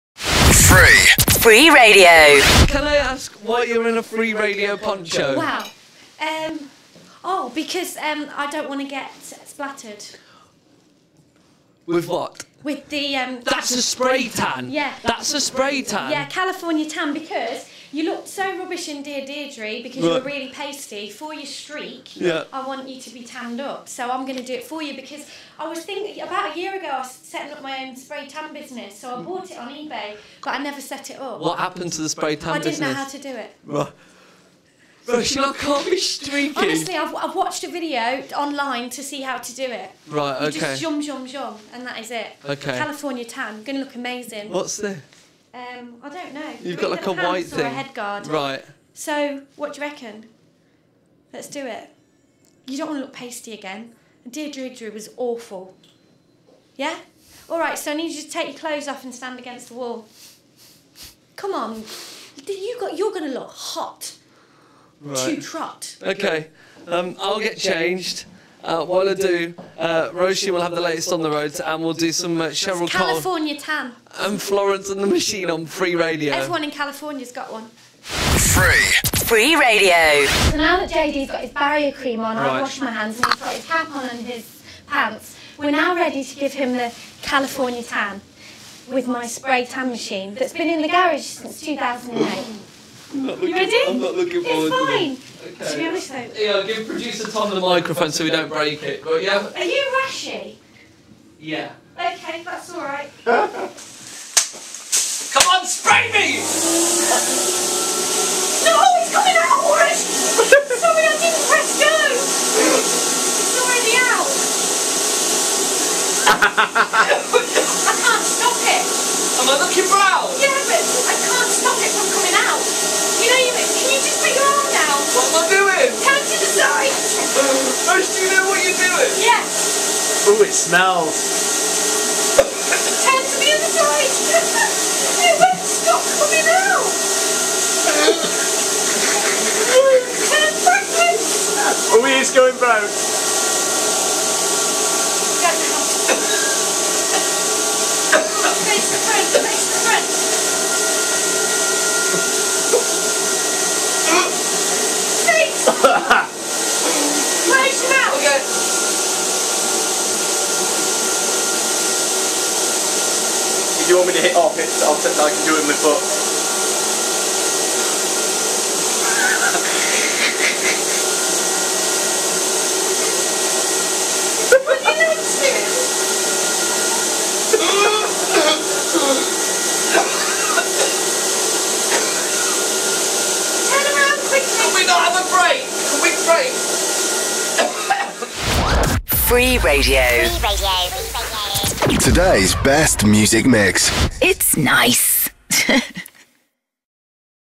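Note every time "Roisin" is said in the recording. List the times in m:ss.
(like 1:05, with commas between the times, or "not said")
0:35, 1:10.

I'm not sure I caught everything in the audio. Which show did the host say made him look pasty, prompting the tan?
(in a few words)
Dear Deirdre.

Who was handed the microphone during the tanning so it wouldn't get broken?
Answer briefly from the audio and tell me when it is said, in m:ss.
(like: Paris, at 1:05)
Producer Tom, at 1:36.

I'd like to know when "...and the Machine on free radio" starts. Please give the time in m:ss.
1:14.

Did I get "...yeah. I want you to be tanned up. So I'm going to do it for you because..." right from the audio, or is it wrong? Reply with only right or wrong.
right.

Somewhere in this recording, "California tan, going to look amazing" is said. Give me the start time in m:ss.
0:42.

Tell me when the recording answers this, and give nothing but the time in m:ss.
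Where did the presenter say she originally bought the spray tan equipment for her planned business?
0:29.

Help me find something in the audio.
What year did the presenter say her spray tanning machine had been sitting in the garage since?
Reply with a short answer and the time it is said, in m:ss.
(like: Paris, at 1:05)
2008, at 1:31.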